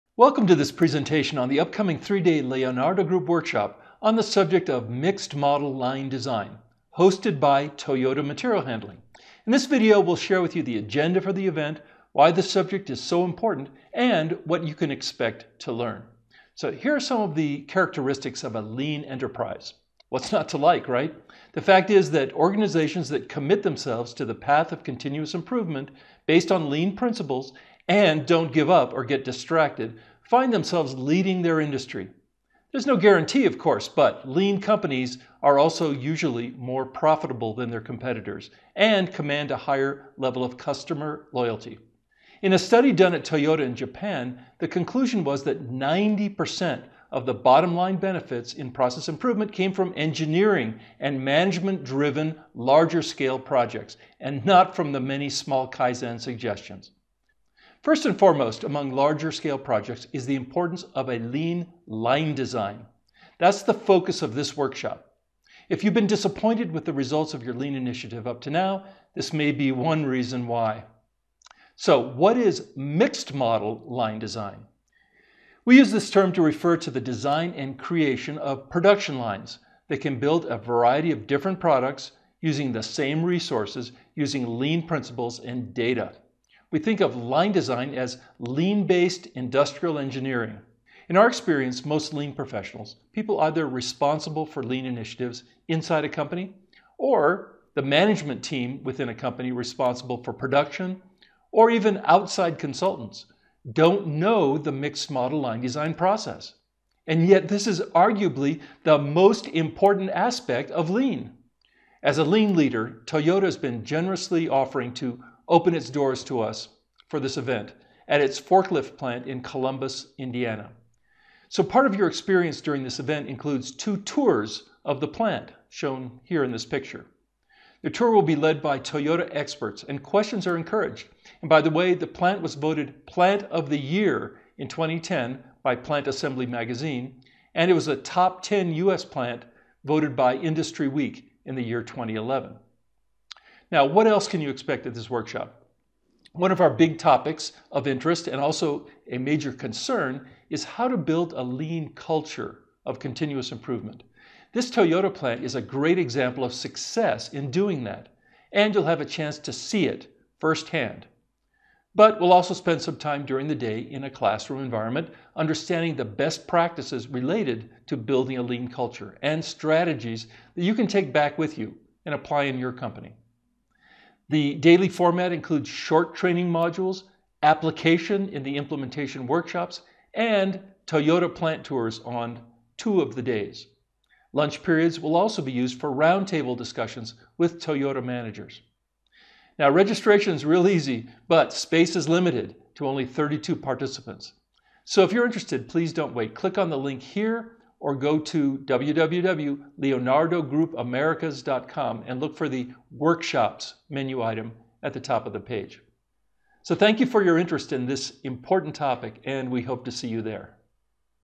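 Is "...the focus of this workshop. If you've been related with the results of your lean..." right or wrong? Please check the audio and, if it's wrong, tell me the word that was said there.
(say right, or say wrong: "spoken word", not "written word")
wrong: "disappointed", not "related".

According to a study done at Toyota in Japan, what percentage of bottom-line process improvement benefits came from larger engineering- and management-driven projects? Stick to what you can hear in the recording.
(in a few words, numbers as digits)
90%.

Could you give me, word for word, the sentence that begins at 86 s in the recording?
We think of line design as lean based industrial engineering.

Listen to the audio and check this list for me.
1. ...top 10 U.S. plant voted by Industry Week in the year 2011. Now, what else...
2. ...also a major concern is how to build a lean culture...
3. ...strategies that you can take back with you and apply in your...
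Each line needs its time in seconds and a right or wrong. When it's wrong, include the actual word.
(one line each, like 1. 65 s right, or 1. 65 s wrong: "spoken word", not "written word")
1. 137 s right
2. 148 s right
3. 169 s right.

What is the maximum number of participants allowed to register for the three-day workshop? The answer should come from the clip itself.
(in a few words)
32.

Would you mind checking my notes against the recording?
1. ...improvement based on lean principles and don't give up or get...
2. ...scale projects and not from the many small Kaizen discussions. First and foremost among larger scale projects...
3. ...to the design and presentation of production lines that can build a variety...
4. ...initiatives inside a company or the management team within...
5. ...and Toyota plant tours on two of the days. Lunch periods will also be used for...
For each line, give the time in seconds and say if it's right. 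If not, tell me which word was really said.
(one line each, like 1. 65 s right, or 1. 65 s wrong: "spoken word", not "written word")
1. 25 s right
2. 53 s wrong: "suggestions", not "discussions"
3. 76 s wrong: "creation", not "presentation"
4. 94 s right
5. 180 s right.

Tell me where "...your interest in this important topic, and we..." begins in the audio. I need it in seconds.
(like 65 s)
207 s.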